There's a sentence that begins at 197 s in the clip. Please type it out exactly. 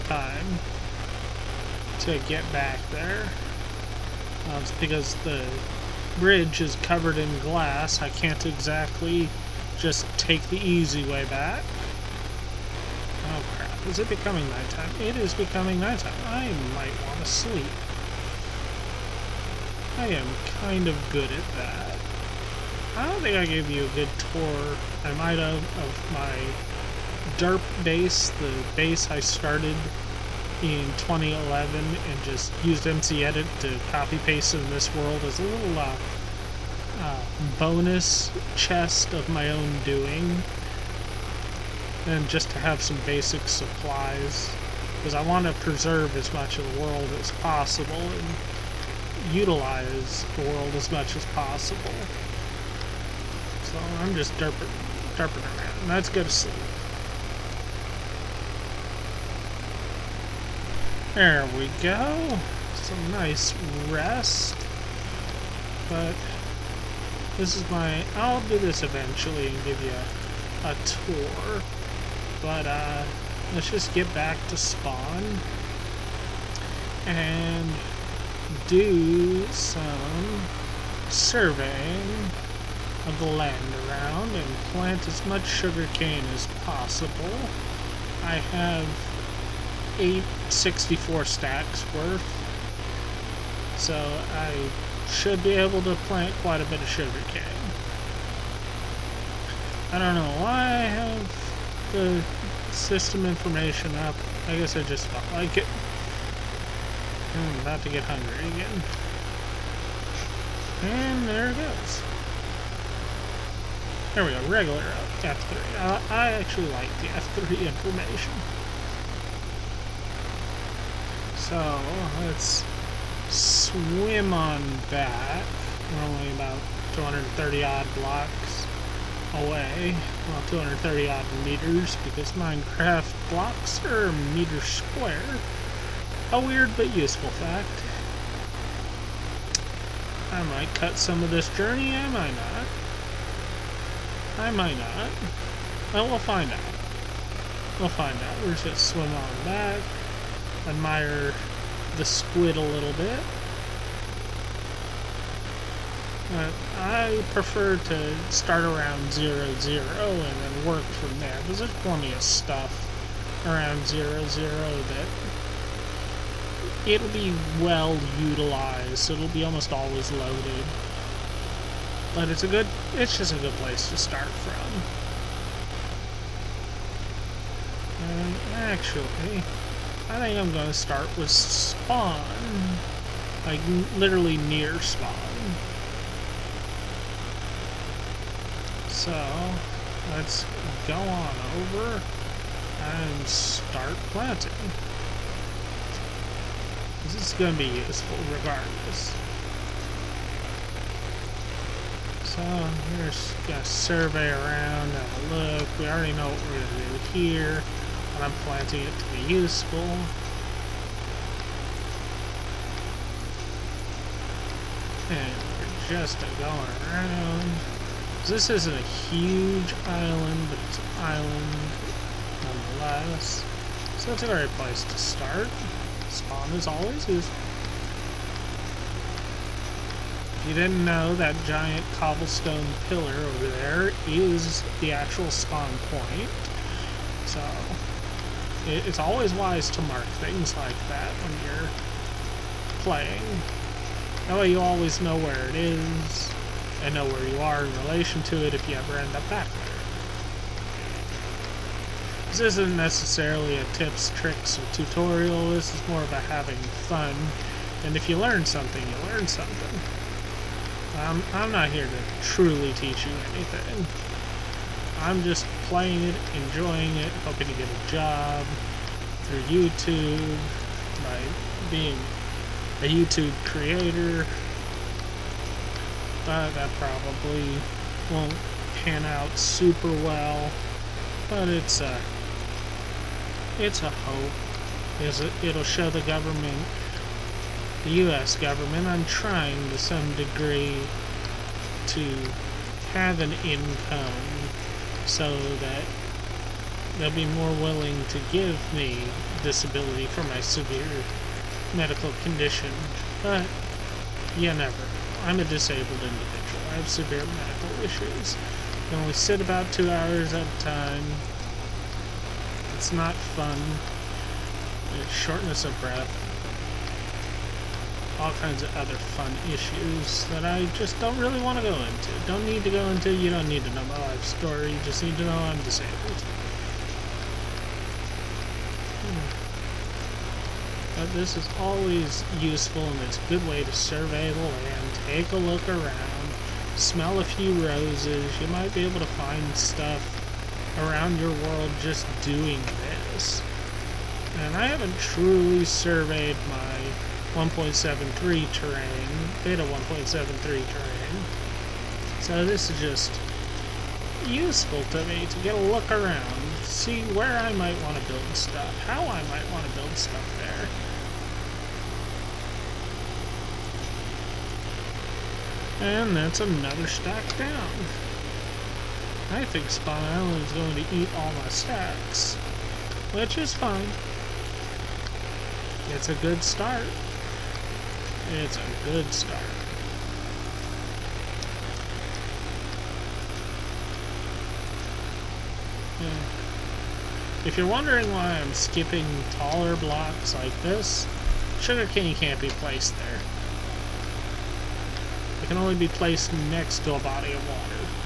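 This is going to be useful regardless.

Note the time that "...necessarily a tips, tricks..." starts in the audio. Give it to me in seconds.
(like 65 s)
252 s.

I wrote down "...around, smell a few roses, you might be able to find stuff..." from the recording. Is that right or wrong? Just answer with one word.
right.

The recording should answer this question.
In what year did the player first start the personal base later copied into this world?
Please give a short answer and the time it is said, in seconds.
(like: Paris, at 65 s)
2011, at 30 s.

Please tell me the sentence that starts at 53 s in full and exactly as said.
So I'm just derping, derping around.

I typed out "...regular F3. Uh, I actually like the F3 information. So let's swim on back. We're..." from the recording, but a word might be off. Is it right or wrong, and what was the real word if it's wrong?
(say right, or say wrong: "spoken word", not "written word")
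right.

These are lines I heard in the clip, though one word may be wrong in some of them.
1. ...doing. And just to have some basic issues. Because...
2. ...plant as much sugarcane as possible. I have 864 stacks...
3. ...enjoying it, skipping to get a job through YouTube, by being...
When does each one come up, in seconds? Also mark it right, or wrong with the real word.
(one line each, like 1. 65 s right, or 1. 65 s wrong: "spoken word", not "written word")
1. 39 s wrong: "supplies", not "issues"
2. 84 s right
3. 266 s wrong: "hoping", not "skipping".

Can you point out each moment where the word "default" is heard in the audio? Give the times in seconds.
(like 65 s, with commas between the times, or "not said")
not said.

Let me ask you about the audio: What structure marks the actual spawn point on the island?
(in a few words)
giant cobblestone pillar.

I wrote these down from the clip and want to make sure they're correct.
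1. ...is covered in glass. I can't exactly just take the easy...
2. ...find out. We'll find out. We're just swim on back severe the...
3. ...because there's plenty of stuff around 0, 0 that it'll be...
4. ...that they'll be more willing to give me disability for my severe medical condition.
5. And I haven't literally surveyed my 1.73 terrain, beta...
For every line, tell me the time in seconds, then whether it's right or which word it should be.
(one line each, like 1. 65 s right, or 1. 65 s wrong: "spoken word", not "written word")
1. 6 s right
2. 146 s wrong: "admire", not "severe"
3. 161 s right
4. 295 s right
5. 344 s wrong: "truly", not "literally".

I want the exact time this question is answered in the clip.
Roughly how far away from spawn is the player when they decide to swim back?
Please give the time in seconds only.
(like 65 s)
130 s.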